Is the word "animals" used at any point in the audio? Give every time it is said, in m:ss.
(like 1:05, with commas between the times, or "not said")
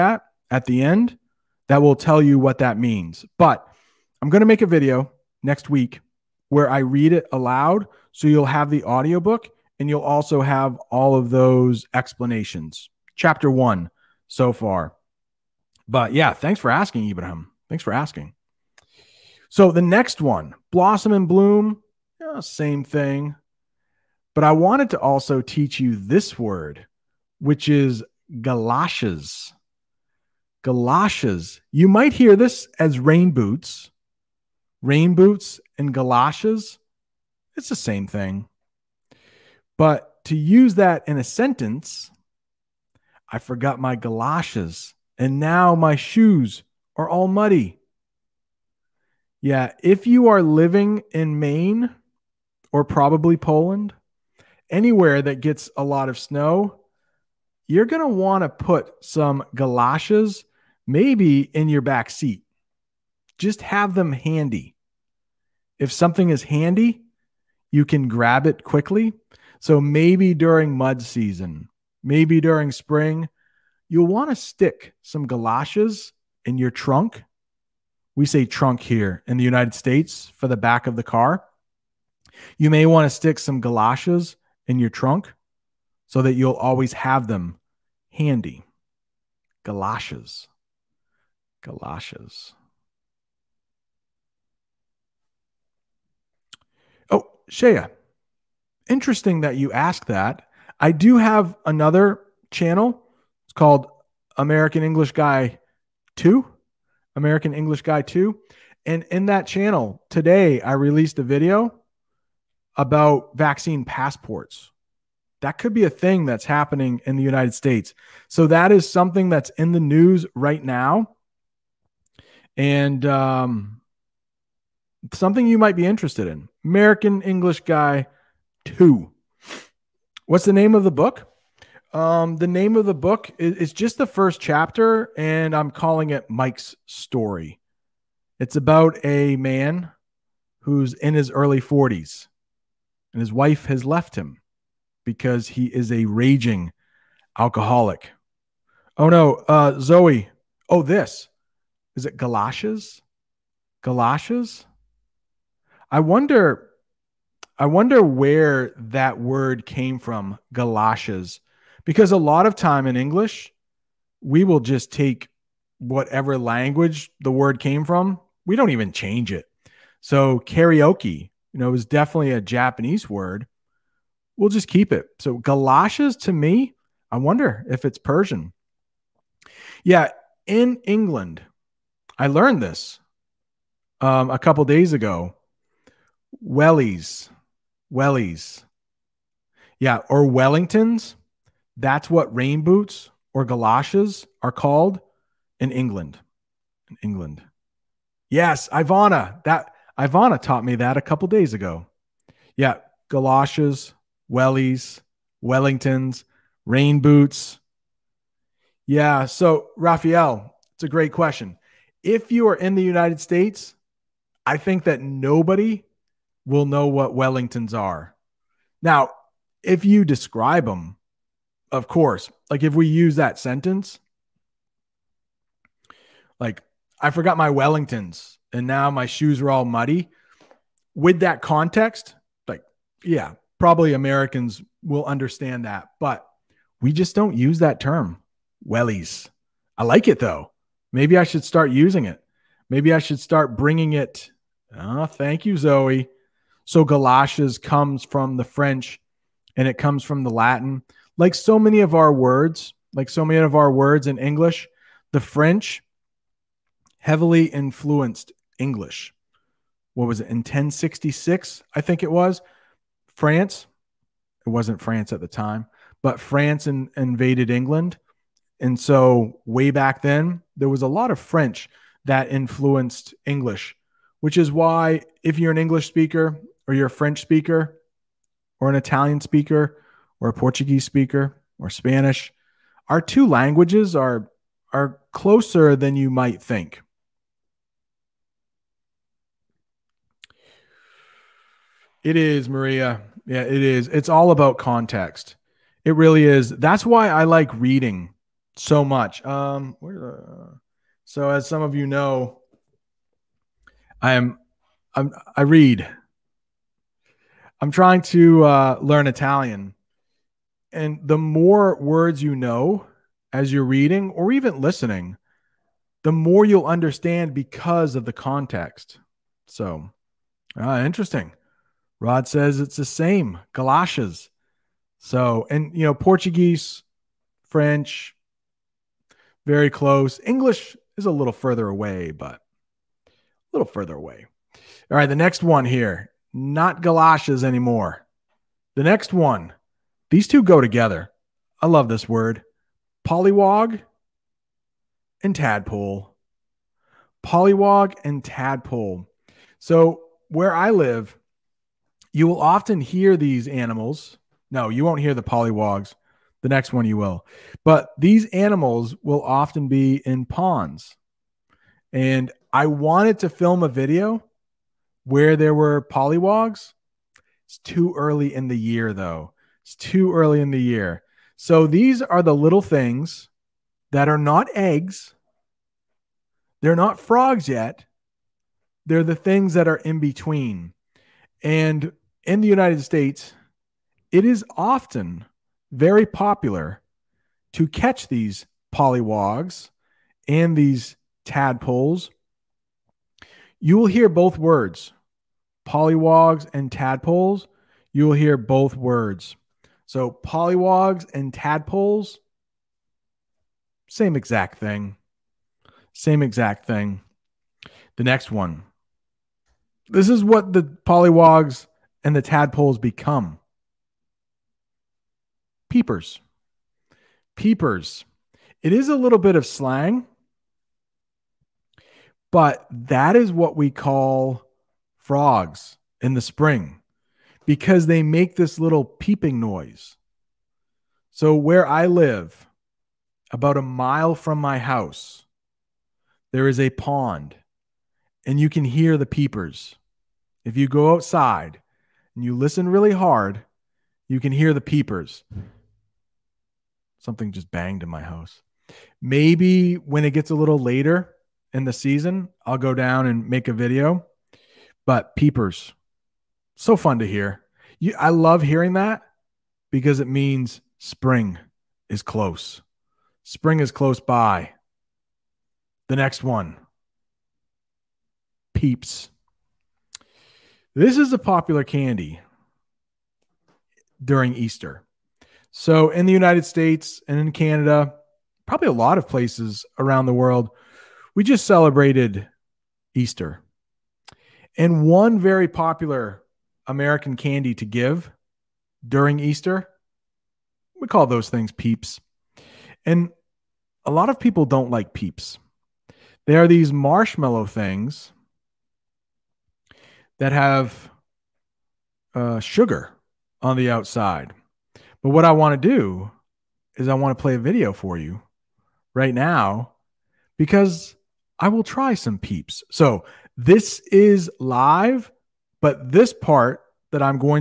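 5:53, 5:58.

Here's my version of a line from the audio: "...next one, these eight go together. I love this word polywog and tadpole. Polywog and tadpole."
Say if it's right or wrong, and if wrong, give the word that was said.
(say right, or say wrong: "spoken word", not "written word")
wrong: "two", not "eight".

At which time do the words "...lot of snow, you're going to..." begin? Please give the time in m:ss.
0:55.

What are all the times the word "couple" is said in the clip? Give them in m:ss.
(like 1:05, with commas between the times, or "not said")
3:04, 3:21.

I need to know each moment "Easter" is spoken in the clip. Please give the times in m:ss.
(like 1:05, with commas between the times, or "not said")
7:54, 8:02, 8:09.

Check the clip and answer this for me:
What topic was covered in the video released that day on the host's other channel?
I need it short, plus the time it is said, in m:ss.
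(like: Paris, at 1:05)
vaccine passports, at 1:53.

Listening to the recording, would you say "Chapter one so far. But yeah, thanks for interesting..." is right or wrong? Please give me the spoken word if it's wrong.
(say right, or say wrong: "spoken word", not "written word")
wrong: "asking", not "interesting".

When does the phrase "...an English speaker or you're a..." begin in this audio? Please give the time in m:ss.
4:35.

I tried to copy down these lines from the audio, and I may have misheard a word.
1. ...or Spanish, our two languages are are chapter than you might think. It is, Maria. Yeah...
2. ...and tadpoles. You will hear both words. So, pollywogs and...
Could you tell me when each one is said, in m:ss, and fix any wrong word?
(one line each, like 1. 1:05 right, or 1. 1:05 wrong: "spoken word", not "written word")
1. 4:41 wrong: "closer", not "chapter"
2. 6:36 right.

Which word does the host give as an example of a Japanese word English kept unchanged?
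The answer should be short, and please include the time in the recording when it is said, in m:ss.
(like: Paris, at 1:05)
karaoke, at 2:50.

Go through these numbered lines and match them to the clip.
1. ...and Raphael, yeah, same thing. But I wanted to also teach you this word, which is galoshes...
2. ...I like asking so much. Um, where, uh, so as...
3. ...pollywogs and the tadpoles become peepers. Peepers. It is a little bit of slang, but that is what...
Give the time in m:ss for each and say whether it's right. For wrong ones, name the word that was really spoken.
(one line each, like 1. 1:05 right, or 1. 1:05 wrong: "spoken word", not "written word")
1. 0:21 wrong: "Bloom", not "Raphael"
2. 4:57 wrong: "reading", not "asking"
3. 6:50 right.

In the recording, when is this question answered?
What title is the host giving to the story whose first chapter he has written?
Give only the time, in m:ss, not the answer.
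2:16.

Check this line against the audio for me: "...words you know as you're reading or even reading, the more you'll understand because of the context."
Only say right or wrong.
wrong.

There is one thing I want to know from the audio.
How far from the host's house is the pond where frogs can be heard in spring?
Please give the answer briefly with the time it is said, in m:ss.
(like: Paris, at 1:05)
about a mile, at 7:13.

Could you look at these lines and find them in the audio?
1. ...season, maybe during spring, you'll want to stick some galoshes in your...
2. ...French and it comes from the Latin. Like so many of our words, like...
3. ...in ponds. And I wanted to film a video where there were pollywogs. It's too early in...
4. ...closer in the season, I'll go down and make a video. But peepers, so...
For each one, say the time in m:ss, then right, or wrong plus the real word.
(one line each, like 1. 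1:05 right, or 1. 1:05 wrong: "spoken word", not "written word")
1. 1:11 right
2. 4:08 right
3. 6:00 right
4. 7:30 wrong: "later", not "closer".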